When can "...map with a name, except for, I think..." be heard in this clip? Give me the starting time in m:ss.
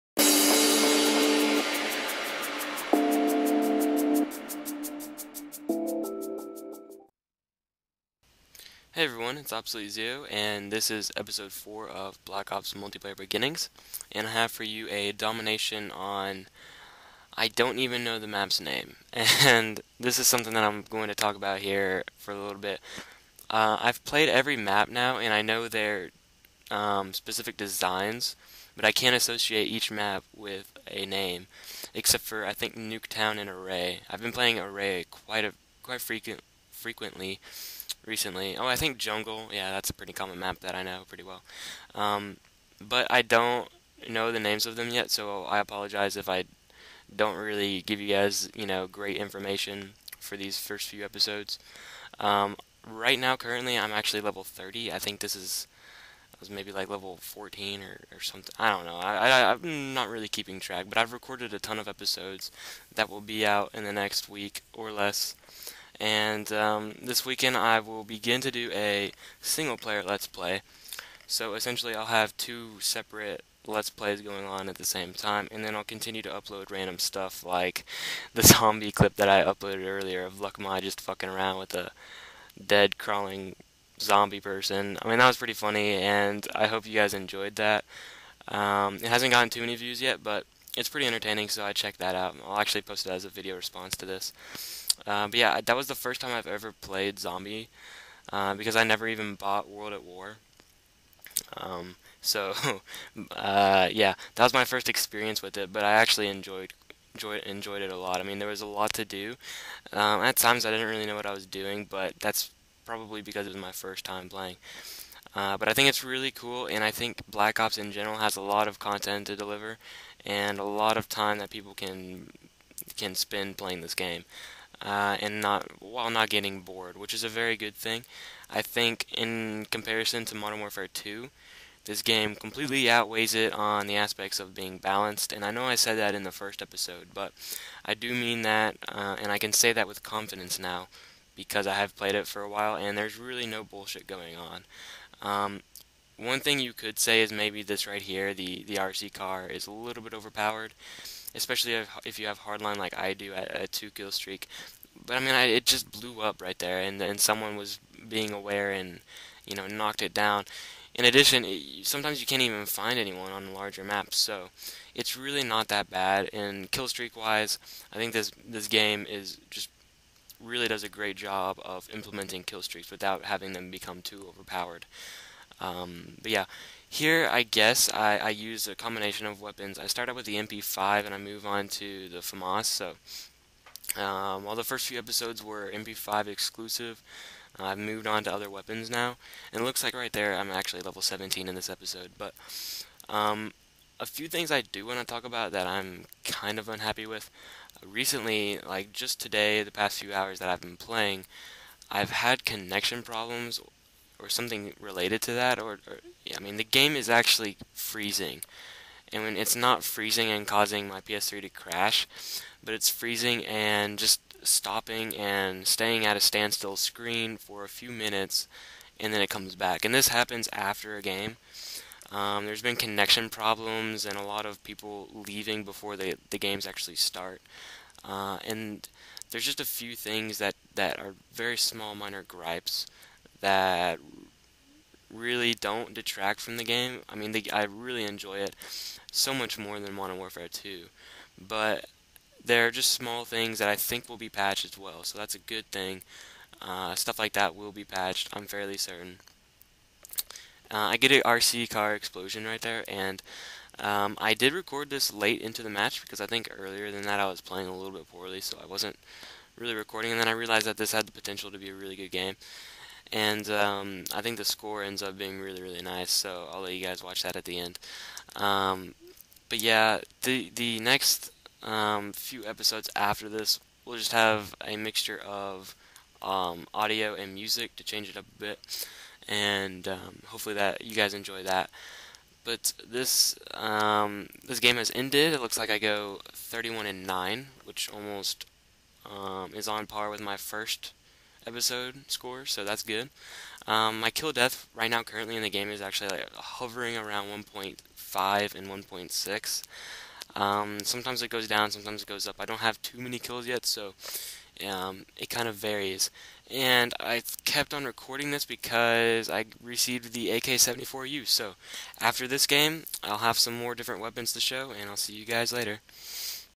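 0:29.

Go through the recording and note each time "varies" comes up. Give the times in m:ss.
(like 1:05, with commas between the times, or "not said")
5:05.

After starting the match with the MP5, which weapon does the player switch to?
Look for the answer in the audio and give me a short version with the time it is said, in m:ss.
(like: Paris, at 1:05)
FAMAS, at 3:02.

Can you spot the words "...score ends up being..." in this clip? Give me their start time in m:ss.
4:24.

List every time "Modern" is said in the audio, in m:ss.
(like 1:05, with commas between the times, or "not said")
2:10, 3:59.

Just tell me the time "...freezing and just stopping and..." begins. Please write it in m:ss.
3:32.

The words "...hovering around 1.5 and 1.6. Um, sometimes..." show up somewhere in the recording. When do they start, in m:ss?
4:56.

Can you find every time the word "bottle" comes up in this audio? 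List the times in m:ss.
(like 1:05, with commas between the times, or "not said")
not said.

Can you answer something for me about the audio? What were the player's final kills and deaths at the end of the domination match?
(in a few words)
31 and 9.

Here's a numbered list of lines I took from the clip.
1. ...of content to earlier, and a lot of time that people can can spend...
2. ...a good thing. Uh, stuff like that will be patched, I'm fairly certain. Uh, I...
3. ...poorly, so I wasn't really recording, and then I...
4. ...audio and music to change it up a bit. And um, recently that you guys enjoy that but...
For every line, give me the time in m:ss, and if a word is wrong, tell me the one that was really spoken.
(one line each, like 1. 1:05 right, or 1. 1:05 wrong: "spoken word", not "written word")
1. 1:58 wrong: "deliver", not "earlier"
2. 4:05 right
3. 4:18 right
4. 4:36 wrong: "hopefully", not "recently".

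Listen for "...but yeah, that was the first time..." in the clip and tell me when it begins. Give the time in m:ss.
1:35.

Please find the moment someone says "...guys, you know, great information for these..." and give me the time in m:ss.
0:48.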